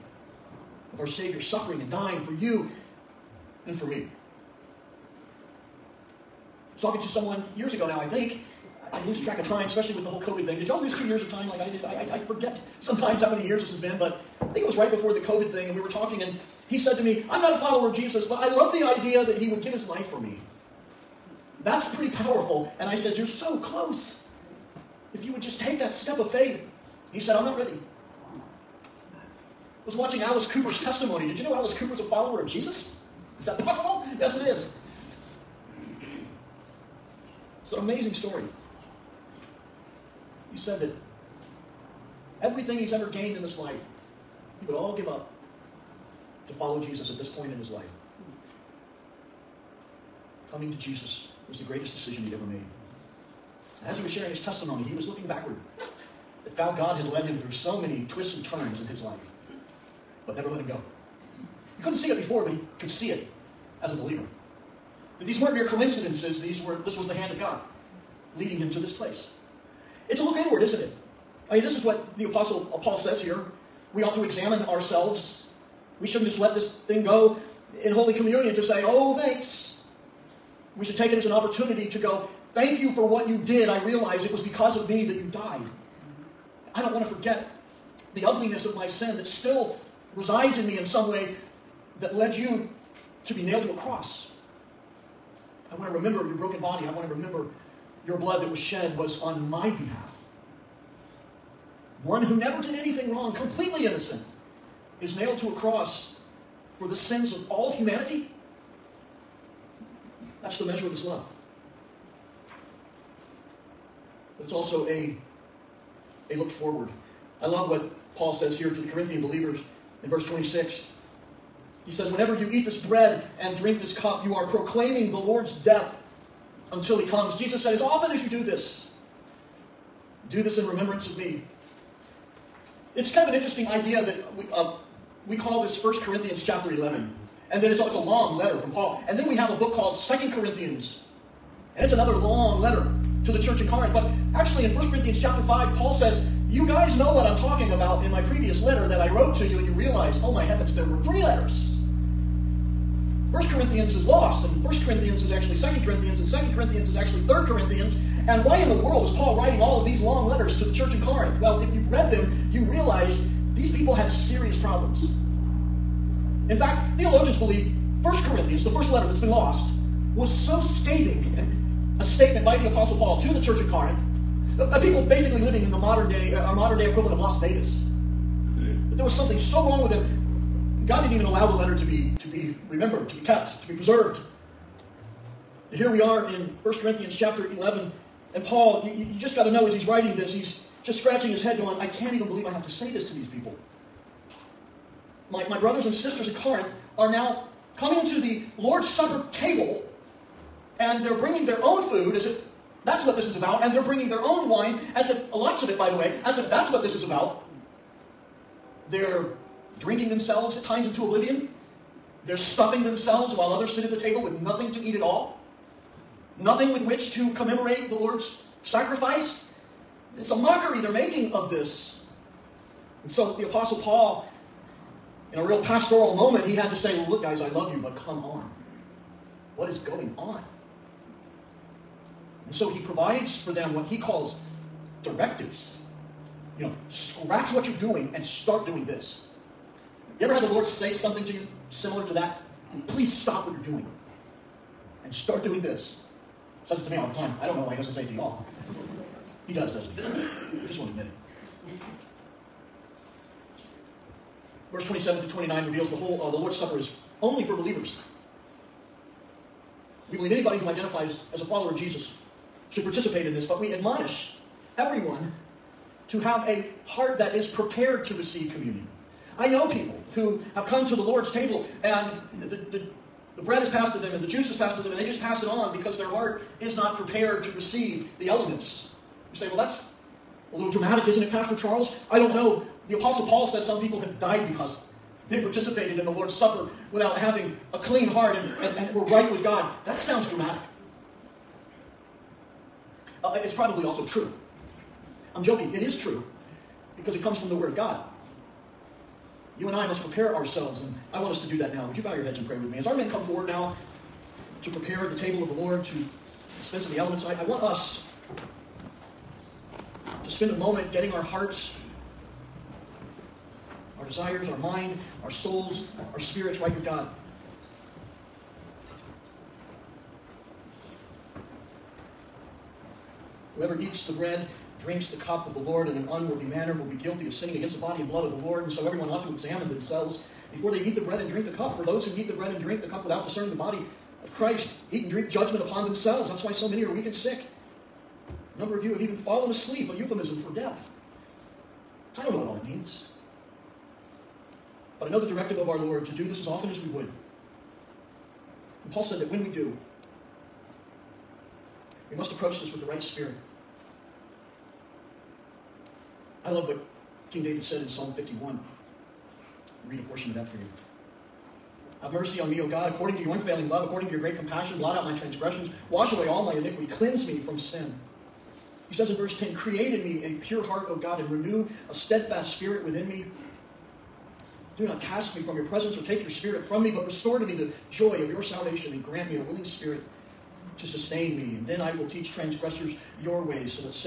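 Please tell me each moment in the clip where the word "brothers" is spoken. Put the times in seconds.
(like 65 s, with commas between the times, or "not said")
195 s.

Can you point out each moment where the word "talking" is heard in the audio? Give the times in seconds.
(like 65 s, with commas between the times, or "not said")
6 s, 15 s, 147 s.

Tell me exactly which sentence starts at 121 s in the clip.
He says, Whenever you eat this bread and drink this cup, you are proclaiming the Lord's death until he comes.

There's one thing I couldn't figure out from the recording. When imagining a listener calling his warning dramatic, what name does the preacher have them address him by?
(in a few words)
Pastor Charles.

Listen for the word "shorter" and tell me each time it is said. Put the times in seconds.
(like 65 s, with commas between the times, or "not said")
not said.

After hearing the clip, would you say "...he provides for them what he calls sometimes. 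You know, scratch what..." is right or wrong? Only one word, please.
wrong.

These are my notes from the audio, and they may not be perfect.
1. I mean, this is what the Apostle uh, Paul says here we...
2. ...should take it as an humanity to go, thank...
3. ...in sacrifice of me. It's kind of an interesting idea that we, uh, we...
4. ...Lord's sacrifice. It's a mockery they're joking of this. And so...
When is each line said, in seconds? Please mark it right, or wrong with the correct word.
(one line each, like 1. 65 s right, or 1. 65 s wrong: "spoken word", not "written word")
1. 71 s right
2. 80 s wrong: "opportunity", not "humanity"
3. 130 s wrong: "remembrance", not "sacrifice"
4. 217 s wrong: "making", not "joking".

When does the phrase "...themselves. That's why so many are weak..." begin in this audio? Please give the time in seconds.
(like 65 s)
335 s.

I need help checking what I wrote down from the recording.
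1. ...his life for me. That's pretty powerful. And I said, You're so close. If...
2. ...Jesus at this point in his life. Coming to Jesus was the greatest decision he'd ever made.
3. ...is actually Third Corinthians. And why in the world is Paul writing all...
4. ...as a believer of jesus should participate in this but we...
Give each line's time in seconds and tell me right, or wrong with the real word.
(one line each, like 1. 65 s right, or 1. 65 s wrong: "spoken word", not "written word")
1. 19 s right
2. 46 s right
3. 156 s right
4. 261 s wrong: "follower", not "believer".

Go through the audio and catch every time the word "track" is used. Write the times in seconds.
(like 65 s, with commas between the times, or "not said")
9 s.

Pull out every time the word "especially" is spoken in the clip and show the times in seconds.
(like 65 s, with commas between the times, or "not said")
9 s.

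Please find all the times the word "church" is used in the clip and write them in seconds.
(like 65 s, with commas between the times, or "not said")
143 s, 160 s, 173 s.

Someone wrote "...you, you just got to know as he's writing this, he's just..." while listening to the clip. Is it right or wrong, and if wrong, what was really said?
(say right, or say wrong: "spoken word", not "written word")
right.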